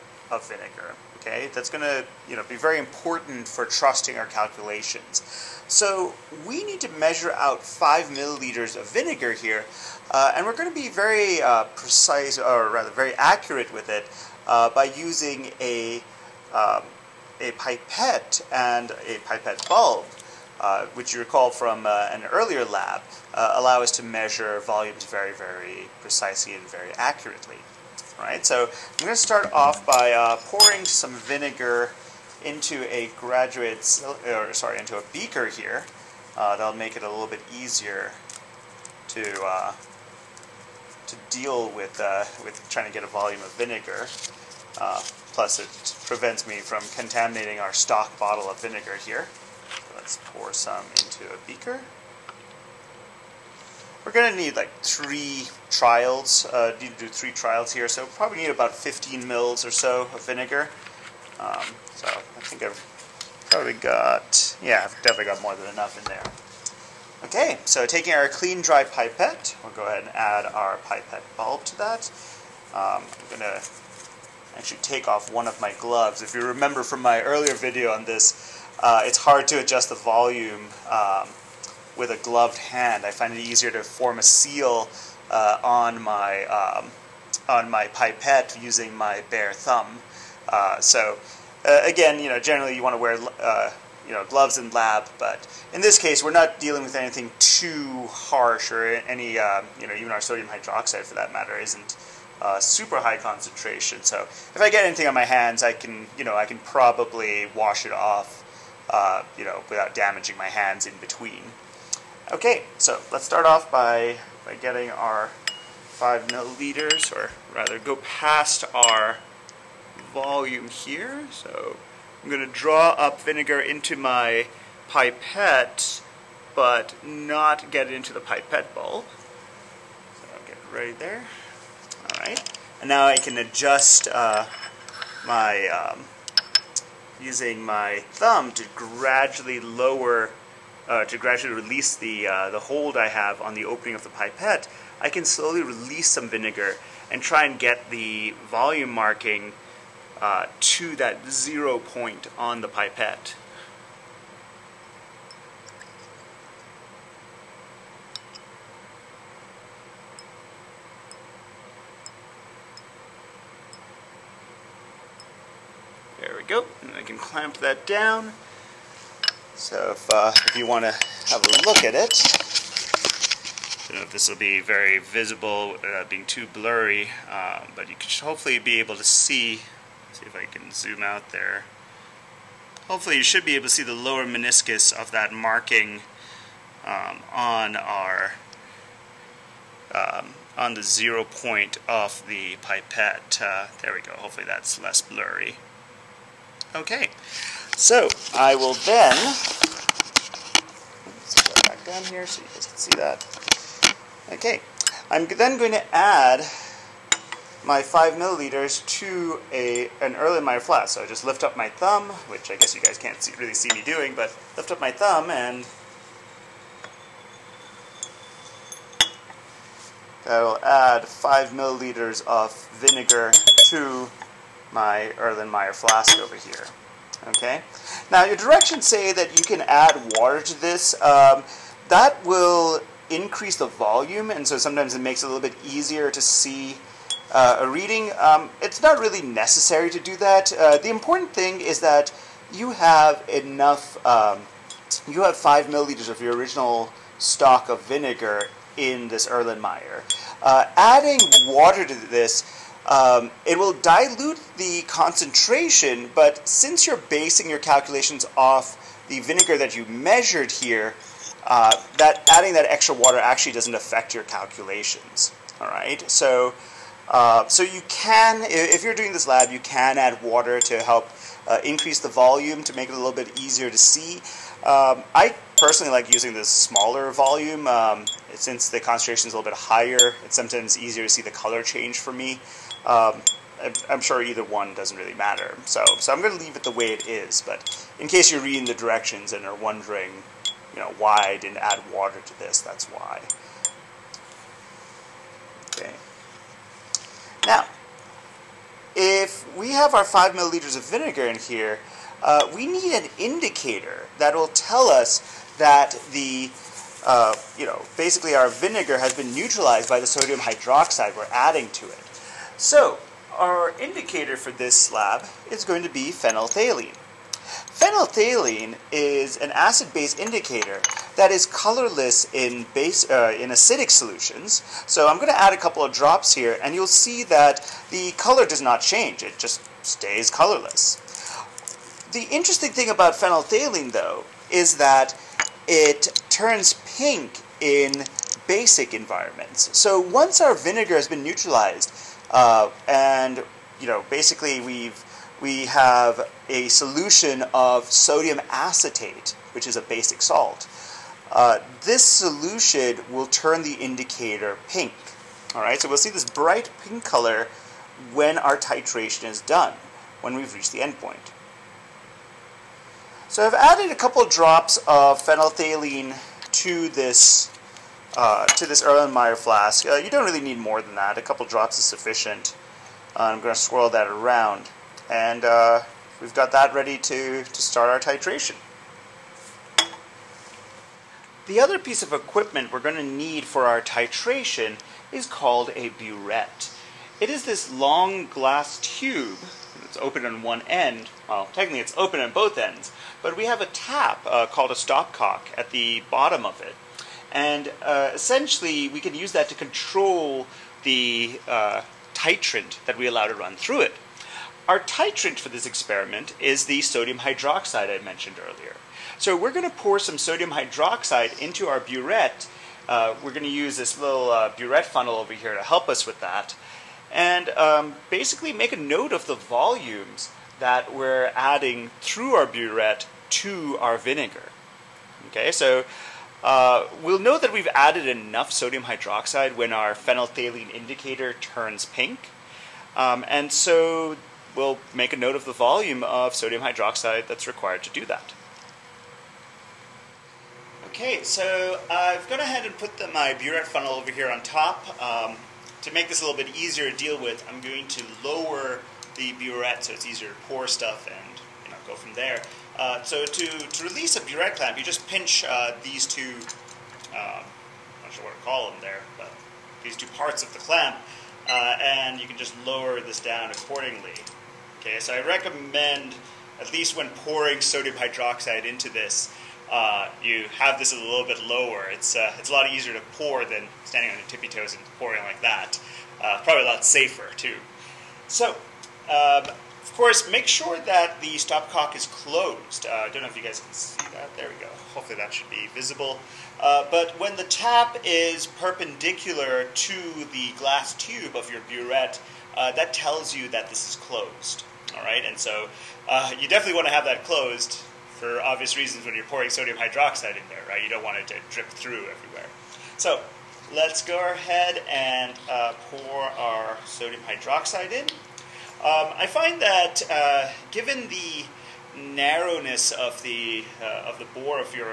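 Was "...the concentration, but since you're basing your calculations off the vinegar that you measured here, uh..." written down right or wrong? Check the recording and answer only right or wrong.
right.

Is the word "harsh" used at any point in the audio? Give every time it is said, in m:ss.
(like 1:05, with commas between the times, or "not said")
1:38.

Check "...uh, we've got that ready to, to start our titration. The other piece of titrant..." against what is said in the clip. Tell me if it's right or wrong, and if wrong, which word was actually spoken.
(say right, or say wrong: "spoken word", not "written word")
wrong: "equipment", not "titrant".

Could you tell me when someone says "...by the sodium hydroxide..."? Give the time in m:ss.
5:09.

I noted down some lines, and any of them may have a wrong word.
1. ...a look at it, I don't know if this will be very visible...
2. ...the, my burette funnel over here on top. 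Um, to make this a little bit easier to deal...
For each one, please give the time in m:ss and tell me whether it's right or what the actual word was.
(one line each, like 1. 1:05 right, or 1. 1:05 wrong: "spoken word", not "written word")
1. 2:51 right
2. 7:22 right.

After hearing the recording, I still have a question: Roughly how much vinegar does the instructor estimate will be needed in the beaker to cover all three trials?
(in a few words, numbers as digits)
15 mL.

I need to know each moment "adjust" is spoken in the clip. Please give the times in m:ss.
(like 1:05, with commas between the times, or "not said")
1:19, 2:13.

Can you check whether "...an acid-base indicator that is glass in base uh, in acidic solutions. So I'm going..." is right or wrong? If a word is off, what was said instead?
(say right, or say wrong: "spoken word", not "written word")
wrong: "colorless", not "glass".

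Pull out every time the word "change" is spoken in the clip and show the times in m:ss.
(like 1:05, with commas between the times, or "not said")
4:41, 5:28.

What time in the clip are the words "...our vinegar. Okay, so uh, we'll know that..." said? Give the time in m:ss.
7:03.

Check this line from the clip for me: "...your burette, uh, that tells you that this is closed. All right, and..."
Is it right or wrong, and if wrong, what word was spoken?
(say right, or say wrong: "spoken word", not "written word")
right.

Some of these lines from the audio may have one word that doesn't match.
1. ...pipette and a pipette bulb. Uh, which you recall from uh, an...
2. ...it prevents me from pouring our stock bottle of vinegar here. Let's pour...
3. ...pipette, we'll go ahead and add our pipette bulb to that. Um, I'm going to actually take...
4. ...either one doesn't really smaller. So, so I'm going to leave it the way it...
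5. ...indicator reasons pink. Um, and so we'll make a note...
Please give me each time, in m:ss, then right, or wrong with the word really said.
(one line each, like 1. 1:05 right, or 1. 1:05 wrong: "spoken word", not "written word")
1. 0:17 right
2. 0:45 wrong: "contaminating", not "pouring"
3. 1:08 right
4. 4:44 wrong: "matter", not "smaller"
5. 7:10 wrong: "turns", not "reasons".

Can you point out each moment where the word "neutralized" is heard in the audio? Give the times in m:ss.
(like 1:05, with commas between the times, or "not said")
5:09, 5:41.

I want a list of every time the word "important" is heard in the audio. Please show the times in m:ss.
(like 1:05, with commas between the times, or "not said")
0:02, 4:00.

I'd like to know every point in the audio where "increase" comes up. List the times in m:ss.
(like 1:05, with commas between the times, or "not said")
3:53, 4:31.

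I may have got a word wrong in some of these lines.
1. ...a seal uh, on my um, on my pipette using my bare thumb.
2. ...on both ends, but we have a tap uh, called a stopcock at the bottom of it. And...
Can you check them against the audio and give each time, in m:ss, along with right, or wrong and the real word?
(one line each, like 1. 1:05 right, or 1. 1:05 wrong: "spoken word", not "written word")
1. 1:24 right
2. 6:32 right.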